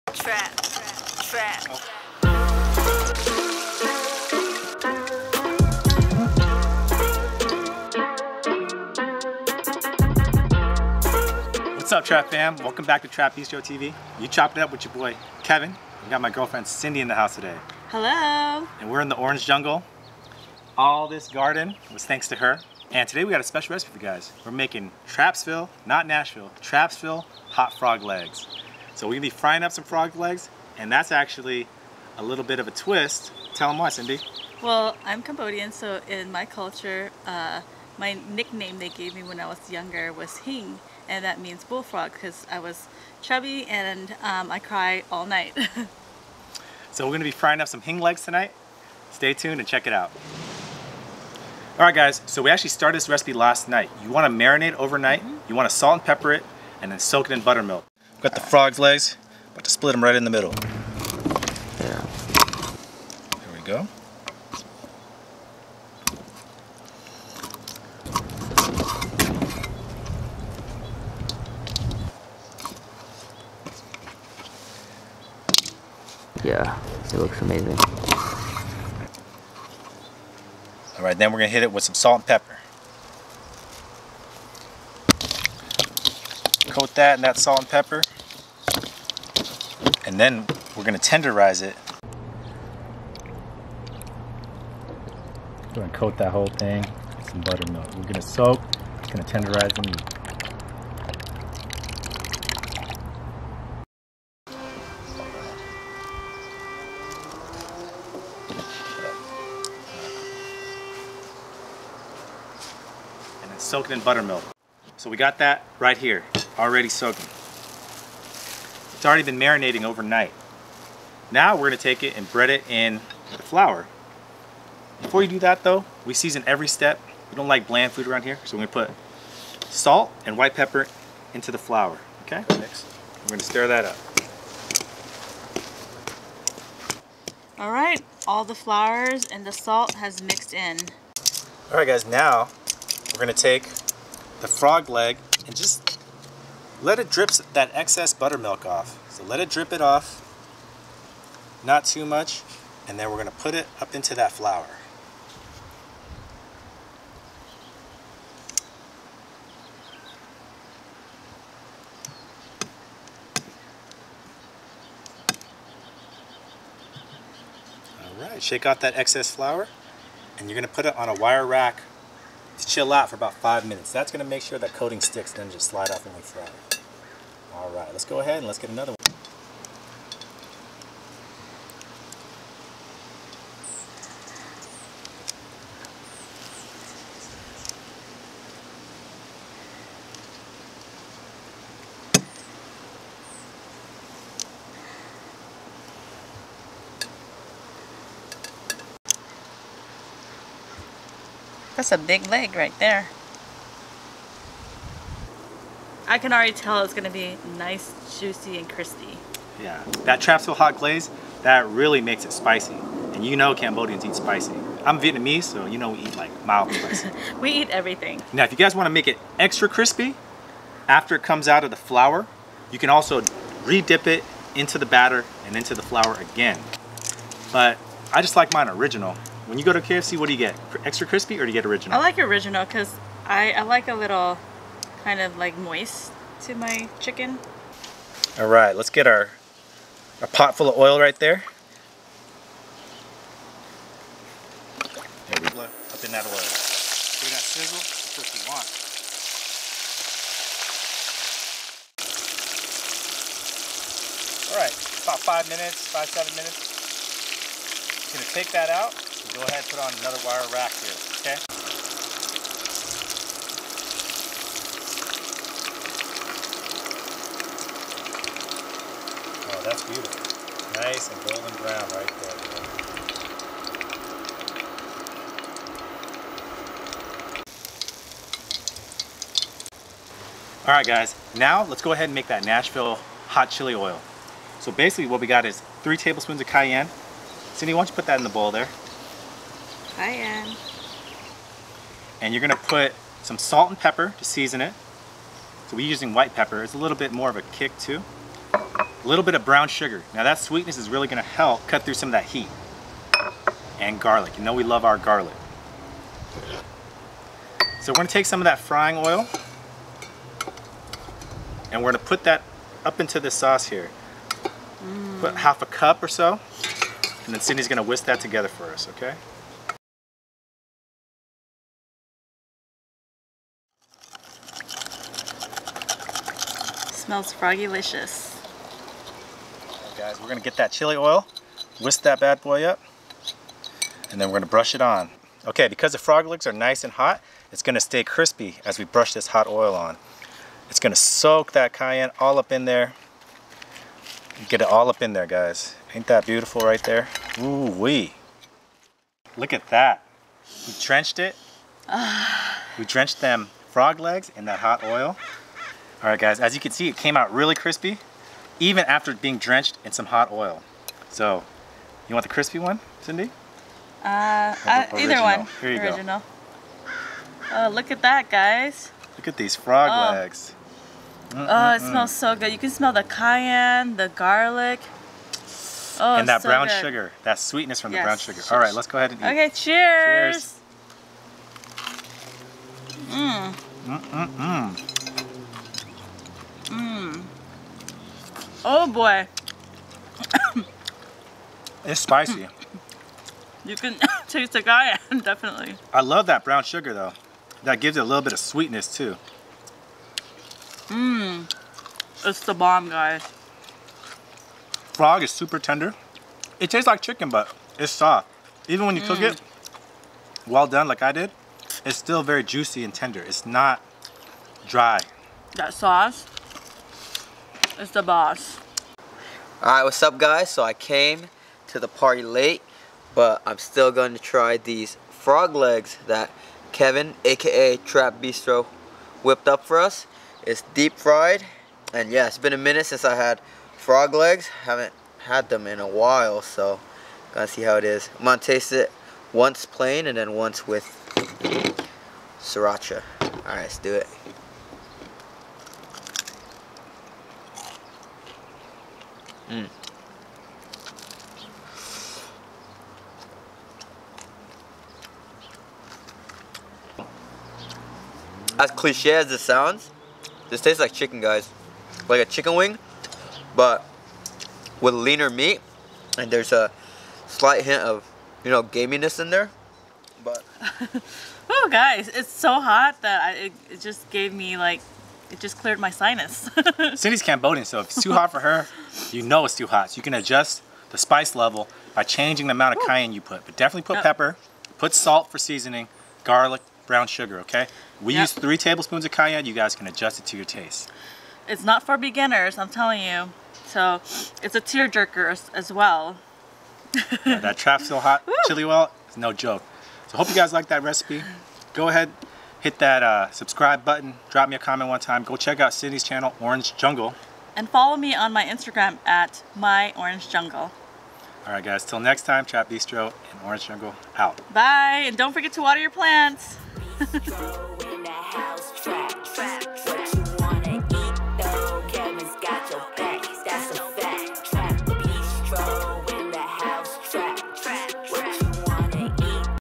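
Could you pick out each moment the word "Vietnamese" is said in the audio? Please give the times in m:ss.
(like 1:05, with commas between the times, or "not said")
3:34.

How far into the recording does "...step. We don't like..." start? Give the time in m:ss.
2:06.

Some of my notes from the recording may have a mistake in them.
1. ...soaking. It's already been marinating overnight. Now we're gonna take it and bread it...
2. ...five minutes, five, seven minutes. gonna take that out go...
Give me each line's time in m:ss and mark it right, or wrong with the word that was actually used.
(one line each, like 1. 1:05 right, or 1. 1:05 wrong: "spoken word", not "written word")
1. 1:56 right
2. 4:15 right.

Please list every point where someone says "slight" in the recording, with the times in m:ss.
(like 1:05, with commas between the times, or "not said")
7:47.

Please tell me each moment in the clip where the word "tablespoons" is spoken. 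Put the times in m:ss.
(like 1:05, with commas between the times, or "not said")
4:45, 8:08.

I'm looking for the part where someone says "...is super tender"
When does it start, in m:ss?
6:45.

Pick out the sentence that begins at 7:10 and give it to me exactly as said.
It's deep fried, and yeah, it's been a minute since I had frog legs.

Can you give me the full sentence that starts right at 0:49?
Stay tuned and check it out.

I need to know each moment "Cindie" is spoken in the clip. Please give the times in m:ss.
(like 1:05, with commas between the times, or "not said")
0:16, 0:33, 4:47, 5:17, 6:03, 7:56, 8:25.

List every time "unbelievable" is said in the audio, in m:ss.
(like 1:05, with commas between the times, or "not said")
not said.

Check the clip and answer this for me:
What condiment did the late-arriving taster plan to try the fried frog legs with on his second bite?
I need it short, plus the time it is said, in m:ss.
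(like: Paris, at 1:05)
Sriracha, at 7:22.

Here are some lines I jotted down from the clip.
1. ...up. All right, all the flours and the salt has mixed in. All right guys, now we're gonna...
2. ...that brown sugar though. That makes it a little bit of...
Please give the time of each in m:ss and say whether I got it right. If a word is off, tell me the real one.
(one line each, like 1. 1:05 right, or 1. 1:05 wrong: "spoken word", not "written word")
1. 2:13 right
2. 6:36 wrong: "gives", not "makes".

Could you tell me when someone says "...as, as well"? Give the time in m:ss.
8:15.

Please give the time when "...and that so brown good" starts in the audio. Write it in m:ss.
6:16.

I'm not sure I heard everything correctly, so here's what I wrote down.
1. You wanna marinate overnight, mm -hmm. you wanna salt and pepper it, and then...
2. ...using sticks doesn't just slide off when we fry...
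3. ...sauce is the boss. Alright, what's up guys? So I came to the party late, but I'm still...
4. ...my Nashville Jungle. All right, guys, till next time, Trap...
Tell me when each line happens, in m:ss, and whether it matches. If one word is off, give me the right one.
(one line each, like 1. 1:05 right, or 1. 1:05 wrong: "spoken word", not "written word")
1. 0:54 right
2. 2:54 wrong: "coating", not "using"
3. 6:55 right
4. 8:29 wrong: "Orange", not "Nashville".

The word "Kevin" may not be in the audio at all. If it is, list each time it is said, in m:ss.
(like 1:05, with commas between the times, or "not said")
0:15, 7:06.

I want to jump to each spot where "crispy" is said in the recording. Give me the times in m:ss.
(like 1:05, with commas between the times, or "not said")
3:28, 3:39, 3:51, 5:38, 5:57, 6:02.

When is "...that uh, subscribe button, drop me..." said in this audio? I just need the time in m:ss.
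8:22.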